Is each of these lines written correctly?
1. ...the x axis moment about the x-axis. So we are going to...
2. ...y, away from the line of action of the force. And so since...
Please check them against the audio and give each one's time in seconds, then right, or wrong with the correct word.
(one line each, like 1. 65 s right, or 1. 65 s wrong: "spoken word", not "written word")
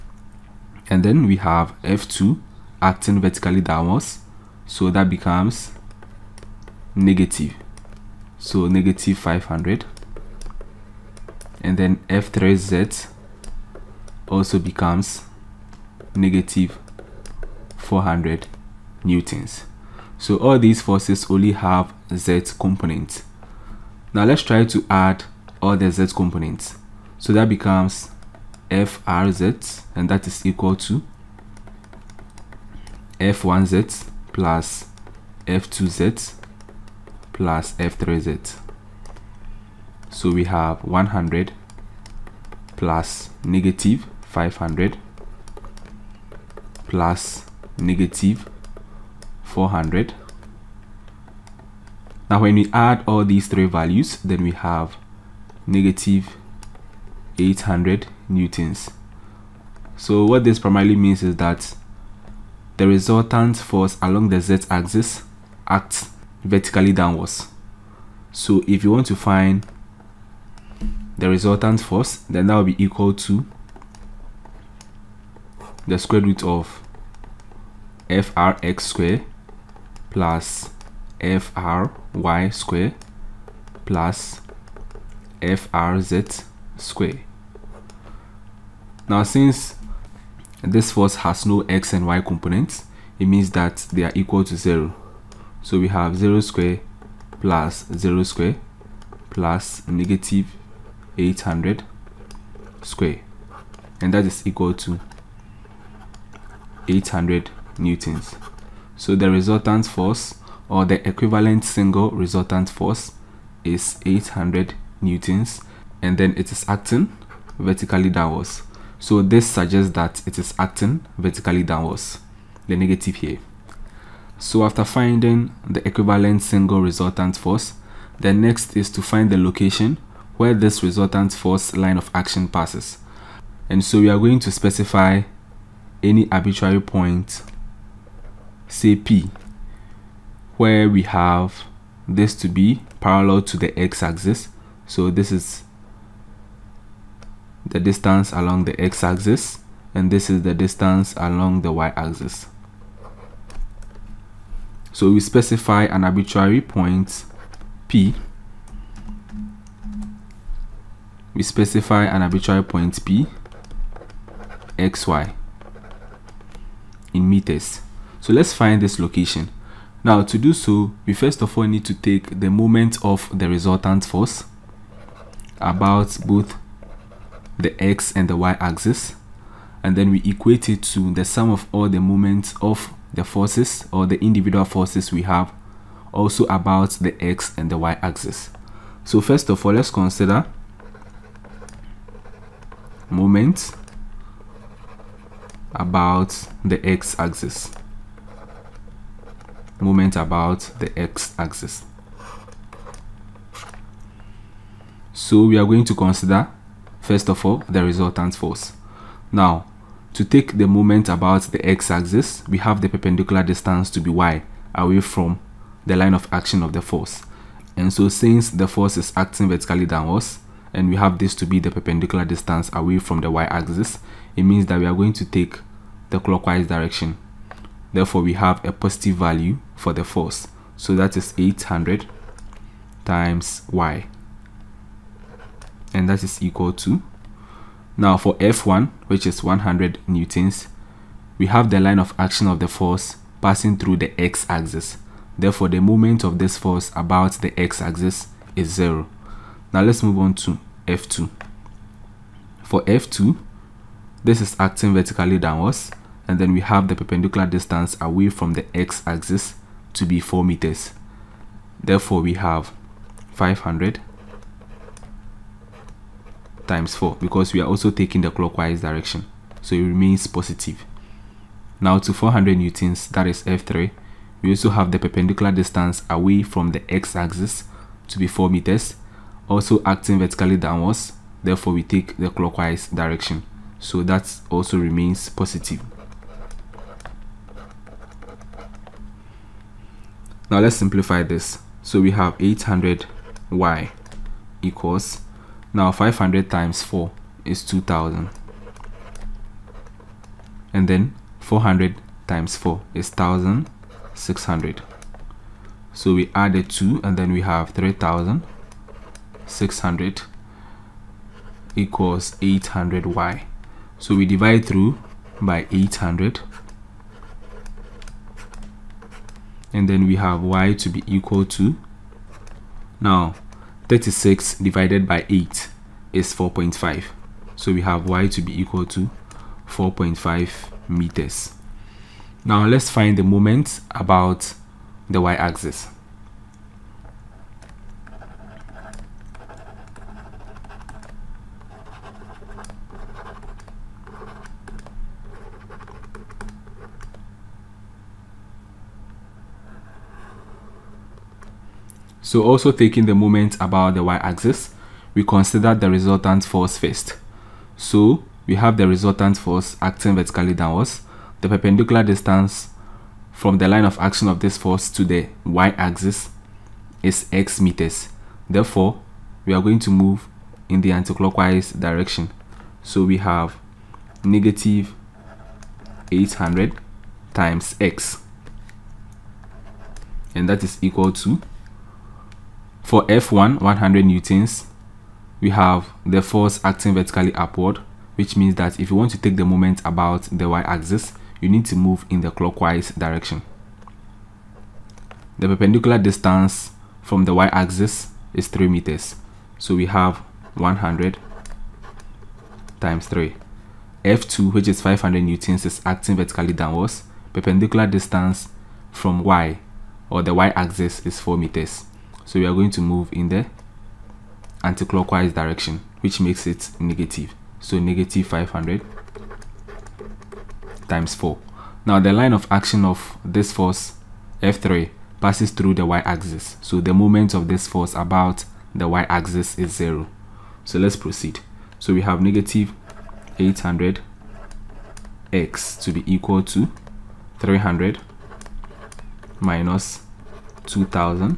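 1. 196 s right
2. 214 s right.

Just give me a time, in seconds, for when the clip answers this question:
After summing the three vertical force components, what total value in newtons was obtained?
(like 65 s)
55 s.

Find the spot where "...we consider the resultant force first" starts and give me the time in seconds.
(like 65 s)
355 s.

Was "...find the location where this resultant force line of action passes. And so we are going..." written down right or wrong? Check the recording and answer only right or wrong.
right.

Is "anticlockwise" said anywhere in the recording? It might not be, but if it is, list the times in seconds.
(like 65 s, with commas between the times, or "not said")
370 s, 414 s.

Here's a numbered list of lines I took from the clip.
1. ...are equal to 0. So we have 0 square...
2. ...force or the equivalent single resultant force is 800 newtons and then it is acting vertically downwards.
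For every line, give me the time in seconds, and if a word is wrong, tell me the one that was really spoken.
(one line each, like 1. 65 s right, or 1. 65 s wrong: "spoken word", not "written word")
1. 94 s right
2. 109 s right.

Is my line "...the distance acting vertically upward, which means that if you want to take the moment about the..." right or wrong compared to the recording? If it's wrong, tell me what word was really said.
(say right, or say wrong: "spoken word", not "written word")
wrong: "force", not "distance".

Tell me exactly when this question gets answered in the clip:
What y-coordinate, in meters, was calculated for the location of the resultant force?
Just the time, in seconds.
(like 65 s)
329 s.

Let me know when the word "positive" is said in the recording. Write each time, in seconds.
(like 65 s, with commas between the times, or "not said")
228 s, 270 s, 285 s.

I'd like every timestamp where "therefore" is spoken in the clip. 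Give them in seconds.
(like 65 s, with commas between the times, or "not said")
227 s, 245 s, 261 s, 281 s, 368 s.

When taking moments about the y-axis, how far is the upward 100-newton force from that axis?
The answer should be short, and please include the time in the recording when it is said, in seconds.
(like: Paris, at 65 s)
3 meters, at 398 s.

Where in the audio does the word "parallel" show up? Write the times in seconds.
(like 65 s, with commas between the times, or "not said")
142 s.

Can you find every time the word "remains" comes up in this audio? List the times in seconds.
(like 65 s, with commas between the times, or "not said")
269 s, 284 s.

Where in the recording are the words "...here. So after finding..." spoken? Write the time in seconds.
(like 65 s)
123 s.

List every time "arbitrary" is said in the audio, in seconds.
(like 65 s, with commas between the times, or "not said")
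136 s, 156 s, 162 s.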